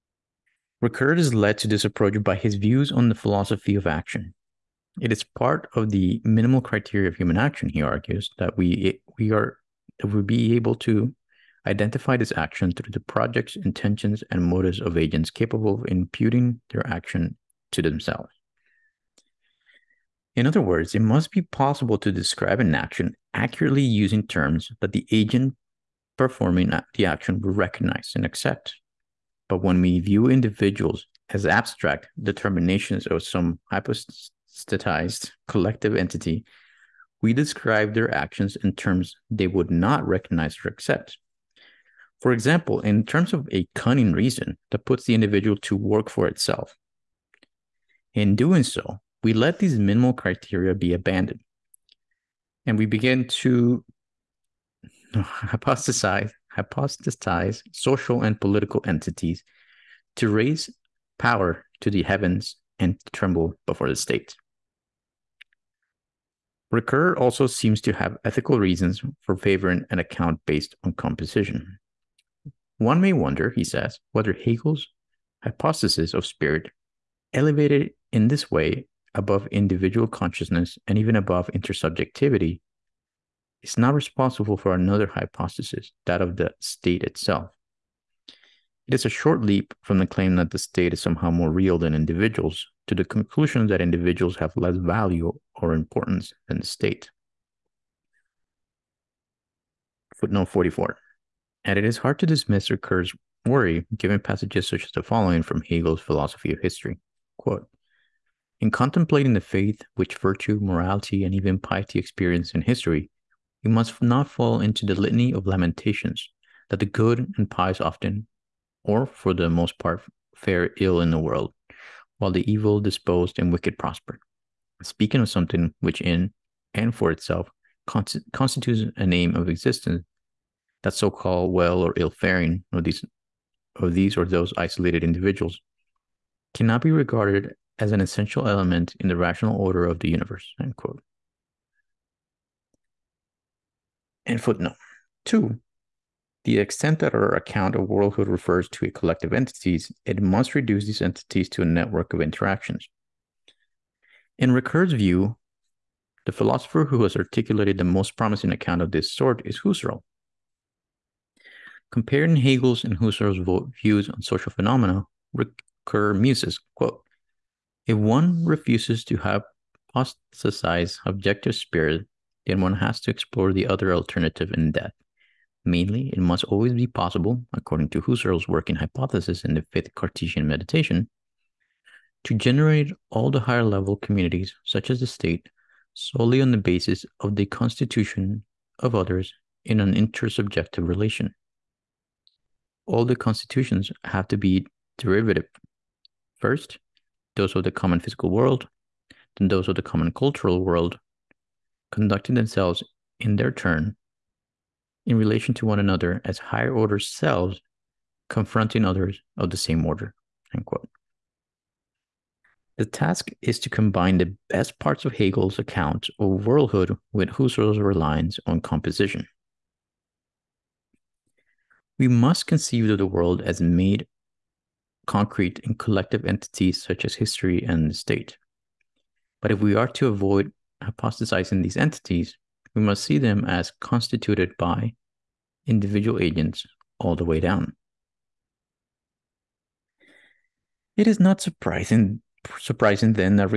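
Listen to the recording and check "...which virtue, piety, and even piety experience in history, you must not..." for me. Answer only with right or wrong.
wrong.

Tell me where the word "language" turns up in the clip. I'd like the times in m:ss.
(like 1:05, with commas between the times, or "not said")
not said.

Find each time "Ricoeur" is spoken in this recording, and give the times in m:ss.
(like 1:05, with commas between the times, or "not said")
0:00, 1:06, 1:42, 2:34, 2:45.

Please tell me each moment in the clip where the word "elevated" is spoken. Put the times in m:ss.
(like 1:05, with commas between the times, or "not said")
1:17.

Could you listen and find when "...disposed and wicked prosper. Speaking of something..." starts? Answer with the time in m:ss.
2:02.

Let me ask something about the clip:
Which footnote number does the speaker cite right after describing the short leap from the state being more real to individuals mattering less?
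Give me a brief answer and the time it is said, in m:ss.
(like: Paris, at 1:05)
44, at 1:40.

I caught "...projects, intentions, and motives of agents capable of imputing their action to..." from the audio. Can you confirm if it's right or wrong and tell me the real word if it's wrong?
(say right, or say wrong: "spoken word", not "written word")
right.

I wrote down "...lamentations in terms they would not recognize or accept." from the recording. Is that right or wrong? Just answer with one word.
wrong.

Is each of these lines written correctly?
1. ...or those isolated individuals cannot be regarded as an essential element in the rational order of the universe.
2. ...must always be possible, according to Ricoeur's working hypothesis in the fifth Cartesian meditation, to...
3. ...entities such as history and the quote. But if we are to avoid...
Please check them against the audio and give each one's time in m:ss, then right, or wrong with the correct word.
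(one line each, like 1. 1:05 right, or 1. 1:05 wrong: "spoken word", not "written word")
1. 2:14 right
2. 2:56 wrong: "Husserl", not "Ricoeur"
3. 3:46 wrong: "state", not "quote".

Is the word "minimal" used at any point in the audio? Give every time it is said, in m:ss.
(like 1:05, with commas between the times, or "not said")
0:06, 0:49.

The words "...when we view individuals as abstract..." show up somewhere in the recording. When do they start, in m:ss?
0:29.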